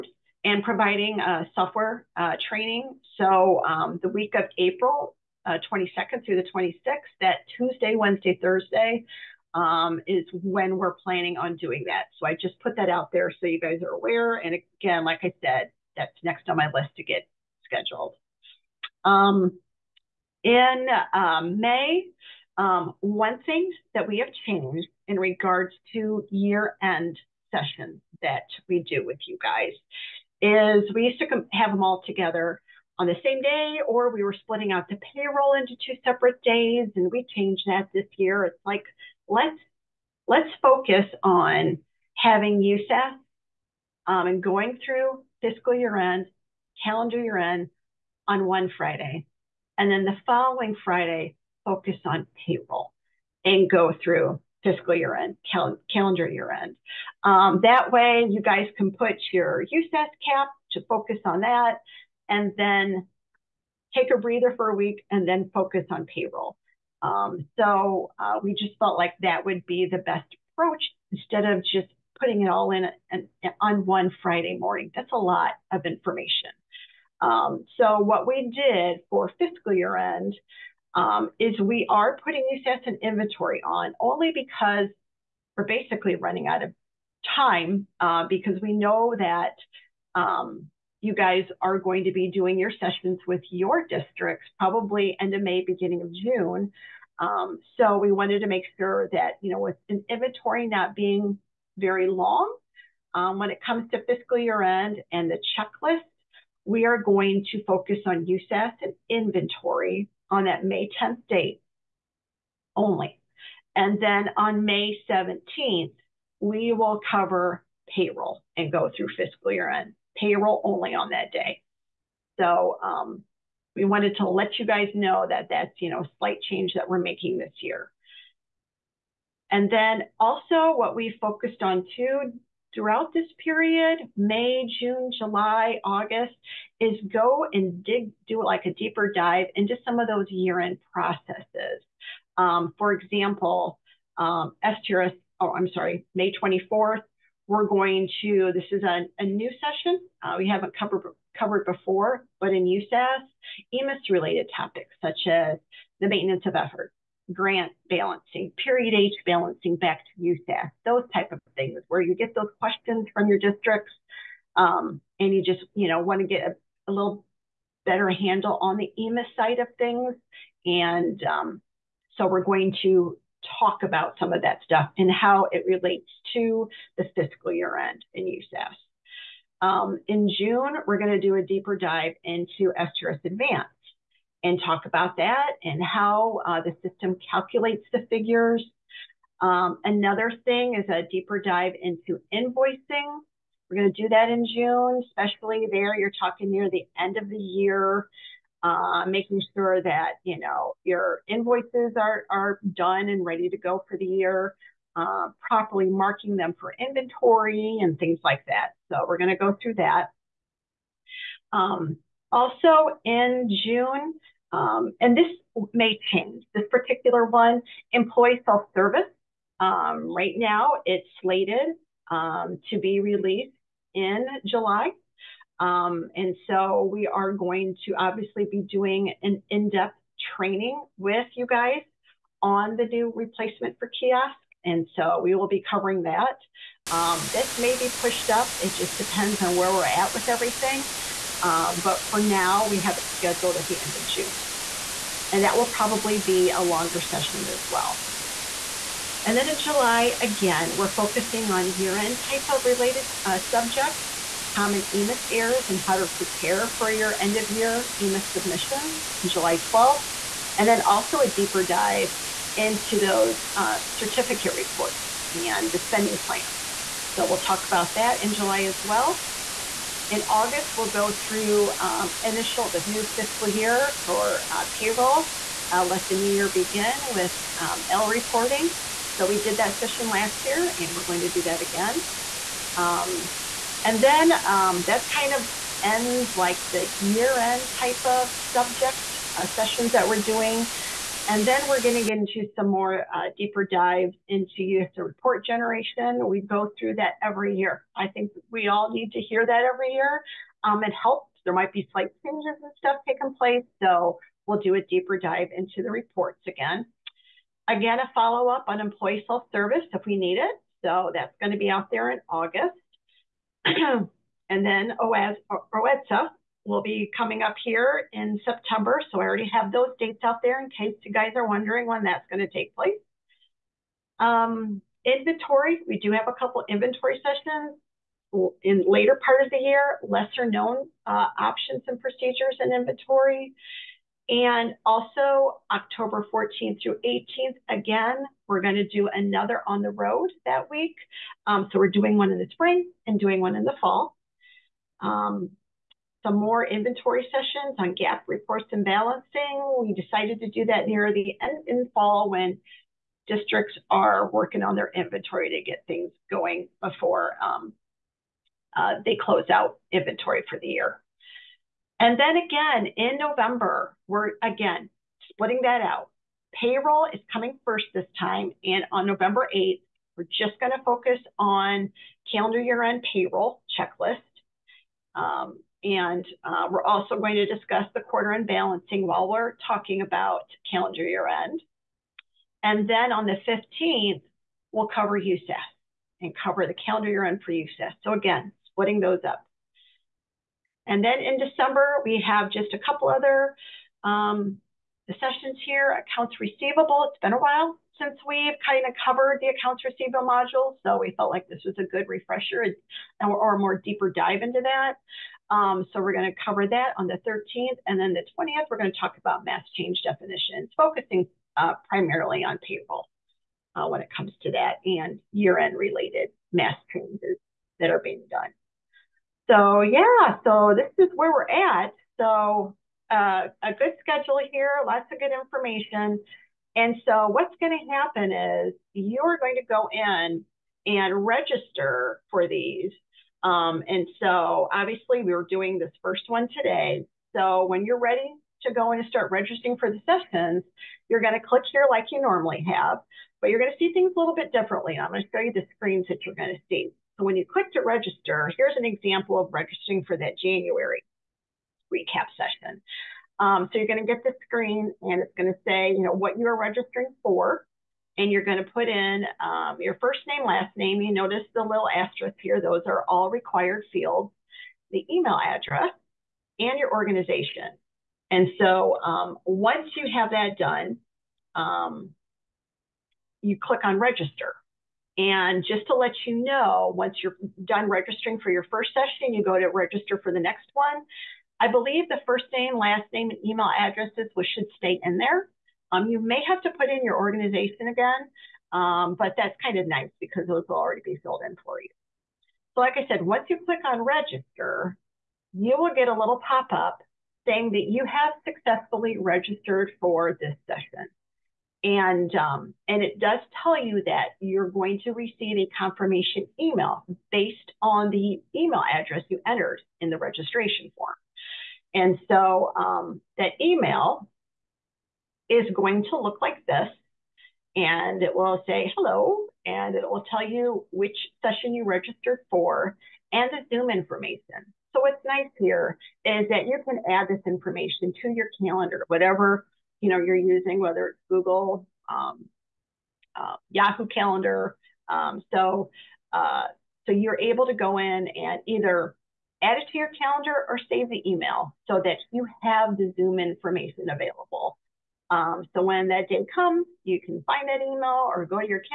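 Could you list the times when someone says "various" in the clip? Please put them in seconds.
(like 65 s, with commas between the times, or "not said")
not said.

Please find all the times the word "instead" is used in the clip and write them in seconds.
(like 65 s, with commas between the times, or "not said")
71 s.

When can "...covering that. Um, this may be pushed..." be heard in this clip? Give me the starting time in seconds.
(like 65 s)
235 s.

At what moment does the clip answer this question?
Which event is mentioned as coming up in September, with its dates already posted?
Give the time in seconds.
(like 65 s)
315 s.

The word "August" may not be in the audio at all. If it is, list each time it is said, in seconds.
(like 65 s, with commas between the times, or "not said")
135 s, 270 s, 312 s.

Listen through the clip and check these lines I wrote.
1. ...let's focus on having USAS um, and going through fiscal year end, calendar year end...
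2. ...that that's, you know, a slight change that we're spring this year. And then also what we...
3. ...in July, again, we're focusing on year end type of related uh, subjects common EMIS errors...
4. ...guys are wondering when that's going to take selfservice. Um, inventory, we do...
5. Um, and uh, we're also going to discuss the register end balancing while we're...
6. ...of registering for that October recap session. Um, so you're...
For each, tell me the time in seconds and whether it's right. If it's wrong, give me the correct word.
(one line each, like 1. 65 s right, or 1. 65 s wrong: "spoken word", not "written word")
1. 40 s right
2. 125 s wrong: "making", not "spring"
3. 249 s right
4. 321 s wrong: "place", not "selfservice"
5. 375 s wrong: "quarter", not "register"
6. 449 s wrong: "January", not "October".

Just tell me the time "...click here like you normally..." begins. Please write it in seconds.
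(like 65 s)
441 s.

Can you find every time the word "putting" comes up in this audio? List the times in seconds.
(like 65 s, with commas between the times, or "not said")
72 s, 82 s.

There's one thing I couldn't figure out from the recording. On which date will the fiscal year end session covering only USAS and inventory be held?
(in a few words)
May 10.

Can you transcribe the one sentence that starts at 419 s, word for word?
So yeah, so this is where we're at.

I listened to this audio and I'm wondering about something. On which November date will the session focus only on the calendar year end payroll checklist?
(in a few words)
November 8.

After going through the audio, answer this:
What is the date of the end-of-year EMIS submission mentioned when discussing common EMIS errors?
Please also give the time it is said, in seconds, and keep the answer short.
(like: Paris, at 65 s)
July 12, at 259 s.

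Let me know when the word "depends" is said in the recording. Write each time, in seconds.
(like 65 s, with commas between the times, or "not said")
238 s.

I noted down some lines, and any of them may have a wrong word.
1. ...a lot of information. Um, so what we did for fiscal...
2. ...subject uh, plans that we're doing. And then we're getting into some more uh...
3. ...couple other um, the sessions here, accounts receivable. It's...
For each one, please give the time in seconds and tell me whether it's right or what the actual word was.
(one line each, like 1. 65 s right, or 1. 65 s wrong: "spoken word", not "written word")
1. 75 s right
2. 288 s wrong: "sessions", not "plans"
3. 392 s right.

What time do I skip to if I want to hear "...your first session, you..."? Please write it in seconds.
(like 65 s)
478 s.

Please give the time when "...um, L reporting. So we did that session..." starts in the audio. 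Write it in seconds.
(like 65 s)
277 s.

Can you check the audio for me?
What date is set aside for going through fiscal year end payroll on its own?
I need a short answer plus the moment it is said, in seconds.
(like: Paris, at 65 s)
May 17, at 114 s.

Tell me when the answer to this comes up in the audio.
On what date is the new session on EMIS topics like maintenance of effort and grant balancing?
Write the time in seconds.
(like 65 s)
146 s.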